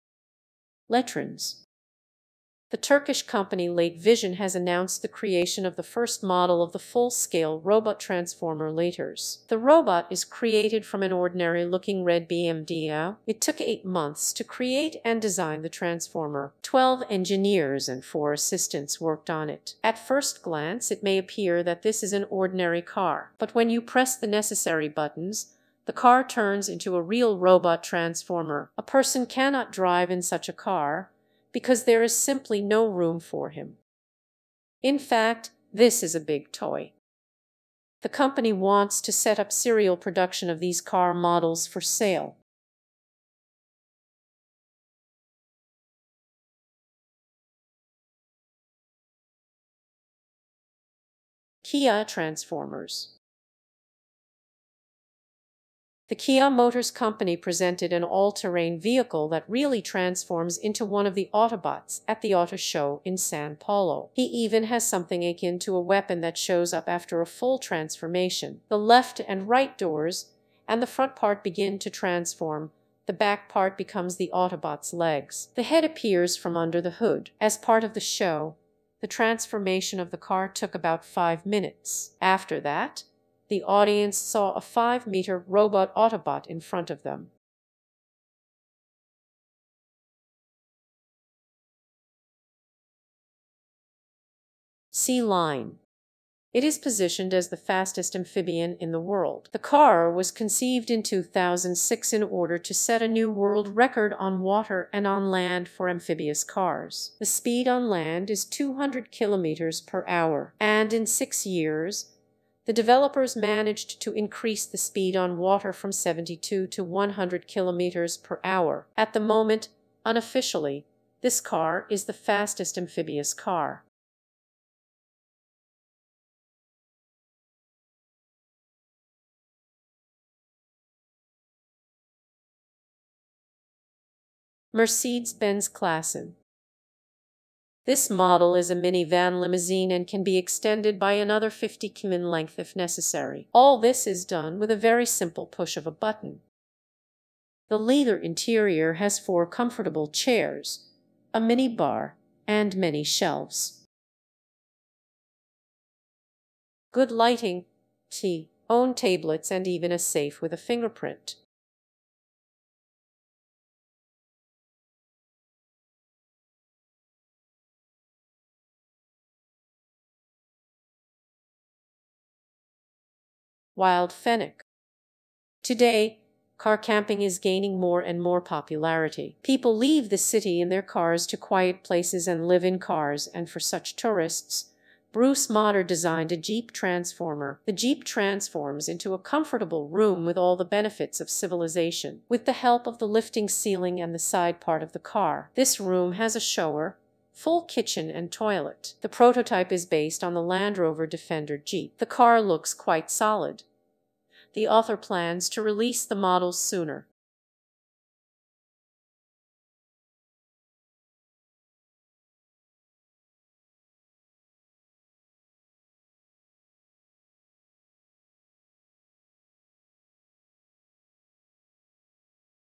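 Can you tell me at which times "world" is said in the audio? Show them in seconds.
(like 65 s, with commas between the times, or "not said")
98 s, 103 s.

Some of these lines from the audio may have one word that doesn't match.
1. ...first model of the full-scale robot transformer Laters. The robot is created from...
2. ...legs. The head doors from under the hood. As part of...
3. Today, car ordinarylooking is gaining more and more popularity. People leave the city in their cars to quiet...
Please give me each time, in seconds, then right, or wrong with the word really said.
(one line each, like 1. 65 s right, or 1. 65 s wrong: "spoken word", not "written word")
1. 5 s right
2. 74 s wrong: "appears", not "doors"
3. 175 s wrong: "camping", not "ordinarylooking".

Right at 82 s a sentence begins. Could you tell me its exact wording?
After that, the audience saw a five-meter robot Autobot in front of them.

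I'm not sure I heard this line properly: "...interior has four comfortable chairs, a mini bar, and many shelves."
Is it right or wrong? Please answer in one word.
right.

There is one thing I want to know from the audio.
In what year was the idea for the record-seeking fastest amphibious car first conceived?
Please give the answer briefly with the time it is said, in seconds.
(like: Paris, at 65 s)
2006, at 101 s.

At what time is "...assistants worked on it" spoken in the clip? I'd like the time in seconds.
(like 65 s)
18 s.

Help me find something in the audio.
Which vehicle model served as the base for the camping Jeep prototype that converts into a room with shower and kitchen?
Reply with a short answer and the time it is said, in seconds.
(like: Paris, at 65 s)
Land Rover Defender, at 200 s.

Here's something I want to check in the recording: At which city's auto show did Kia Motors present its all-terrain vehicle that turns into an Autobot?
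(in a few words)
San Paulo.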